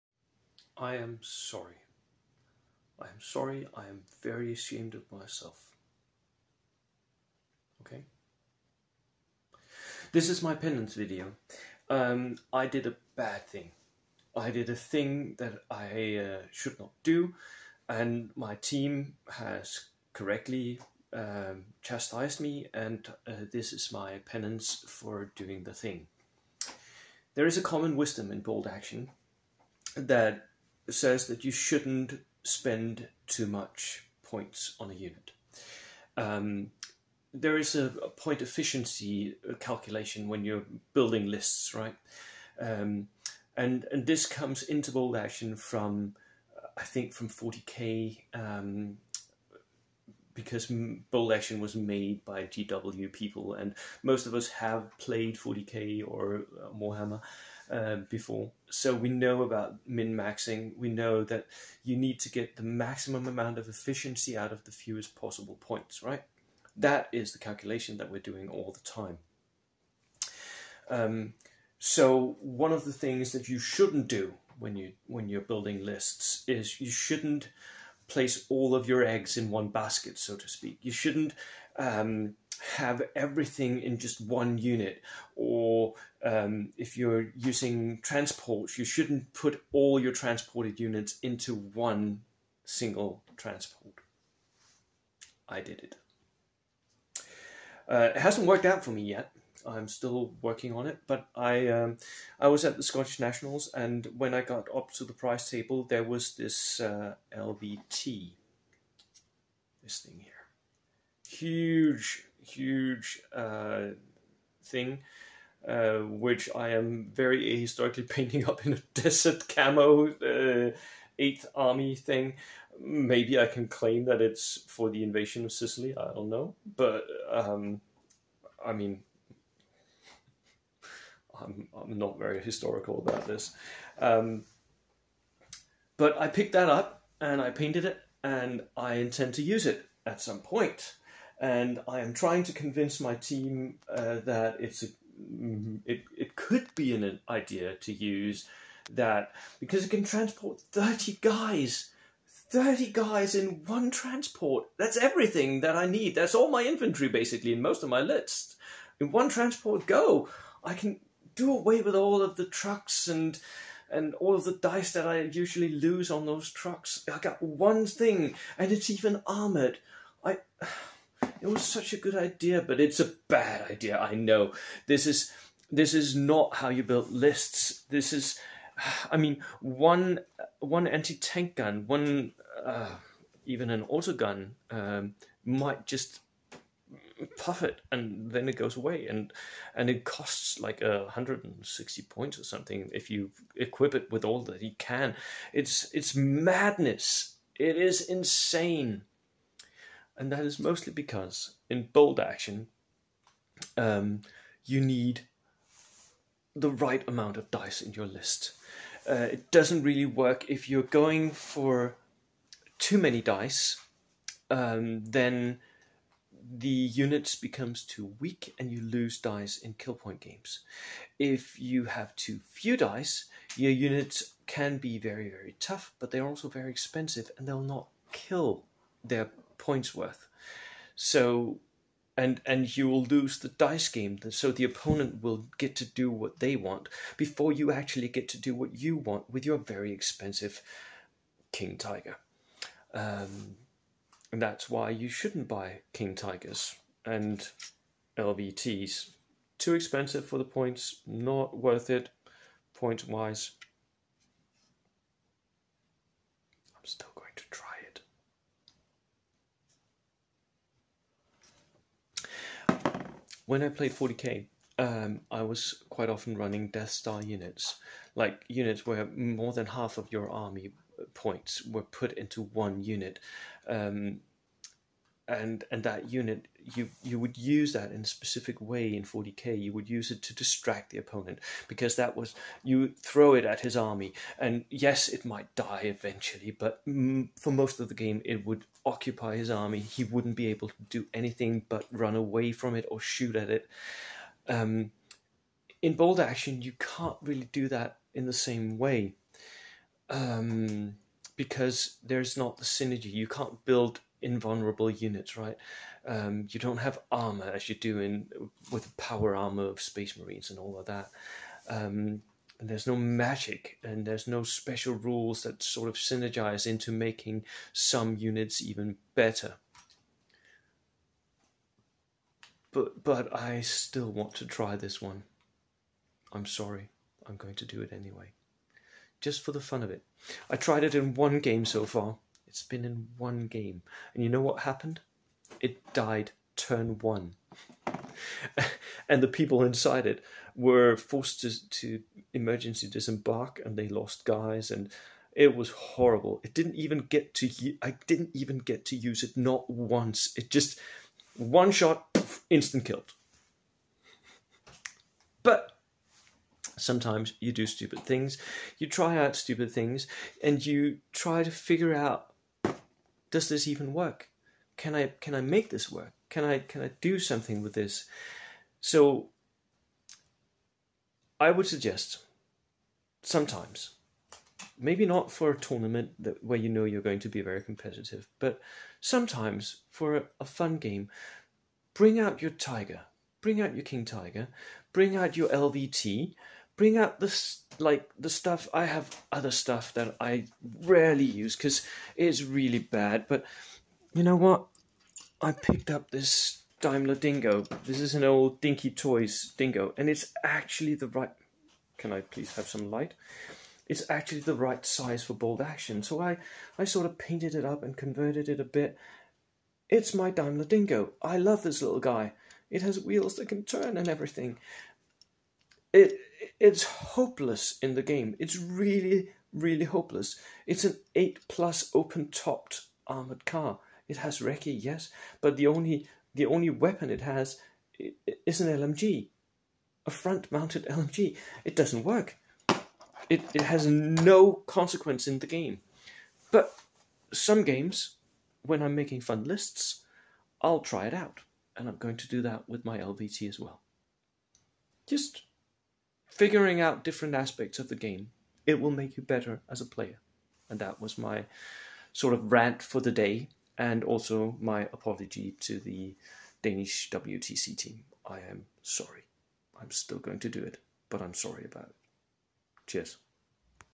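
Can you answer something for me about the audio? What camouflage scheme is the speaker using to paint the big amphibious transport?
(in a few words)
desert camo.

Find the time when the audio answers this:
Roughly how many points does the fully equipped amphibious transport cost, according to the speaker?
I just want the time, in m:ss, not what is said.
3:11.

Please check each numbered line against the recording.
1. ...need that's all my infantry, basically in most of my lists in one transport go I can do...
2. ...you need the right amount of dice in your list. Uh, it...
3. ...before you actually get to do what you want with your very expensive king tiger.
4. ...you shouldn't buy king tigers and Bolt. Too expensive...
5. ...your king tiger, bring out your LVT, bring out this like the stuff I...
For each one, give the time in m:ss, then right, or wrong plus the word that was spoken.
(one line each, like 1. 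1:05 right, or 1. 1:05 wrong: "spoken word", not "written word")
1. 2:35 right
2. 3:24 right
3. 3:57 right
4. 4:04 wrong: "LVTs", not "Bolt"
5. 6:23 right.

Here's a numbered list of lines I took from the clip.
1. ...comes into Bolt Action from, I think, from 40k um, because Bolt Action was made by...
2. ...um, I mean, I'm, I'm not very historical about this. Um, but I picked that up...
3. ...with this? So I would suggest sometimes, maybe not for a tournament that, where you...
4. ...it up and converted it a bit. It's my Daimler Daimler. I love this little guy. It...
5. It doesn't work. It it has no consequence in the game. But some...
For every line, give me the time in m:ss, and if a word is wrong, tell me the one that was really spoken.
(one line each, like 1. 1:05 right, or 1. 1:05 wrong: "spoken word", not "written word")
1. 0:44 right
2. 2:07 right
3. 6:07 right
4. 6:47 wrong: "Dingo", not "Daimler"
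5. 7:11 right.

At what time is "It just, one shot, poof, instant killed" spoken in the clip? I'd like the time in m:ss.
5:50.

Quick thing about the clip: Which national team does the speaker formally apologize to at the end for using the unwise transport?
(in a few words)
Danish WTC team.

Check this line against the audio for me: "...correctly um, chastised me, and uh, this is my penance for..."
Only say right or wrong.
right.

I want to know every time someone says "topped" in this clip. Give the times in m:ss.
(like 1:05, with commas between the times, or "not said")
7:02.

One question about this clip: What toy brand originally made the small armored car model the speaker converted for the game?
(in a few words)
Dinky Toys.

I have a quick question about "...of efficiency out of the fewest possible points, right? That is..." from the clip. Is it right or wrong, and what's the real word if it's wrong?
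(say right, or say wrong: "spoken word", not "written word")
right.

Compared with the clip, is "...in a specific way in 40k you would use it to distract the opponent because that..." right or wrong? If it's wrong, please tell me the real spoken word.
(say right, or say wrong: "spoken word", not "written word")
right.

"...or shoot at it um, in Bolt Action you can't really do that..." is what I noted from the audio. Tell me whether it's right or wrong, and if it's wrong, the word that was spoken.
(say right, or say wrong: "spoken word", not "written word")
right.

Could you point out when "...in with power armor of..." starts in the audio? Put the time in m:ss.
5:07.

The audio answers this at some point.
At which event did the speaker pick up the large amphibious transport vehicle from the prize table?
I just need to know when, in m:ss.
1:42.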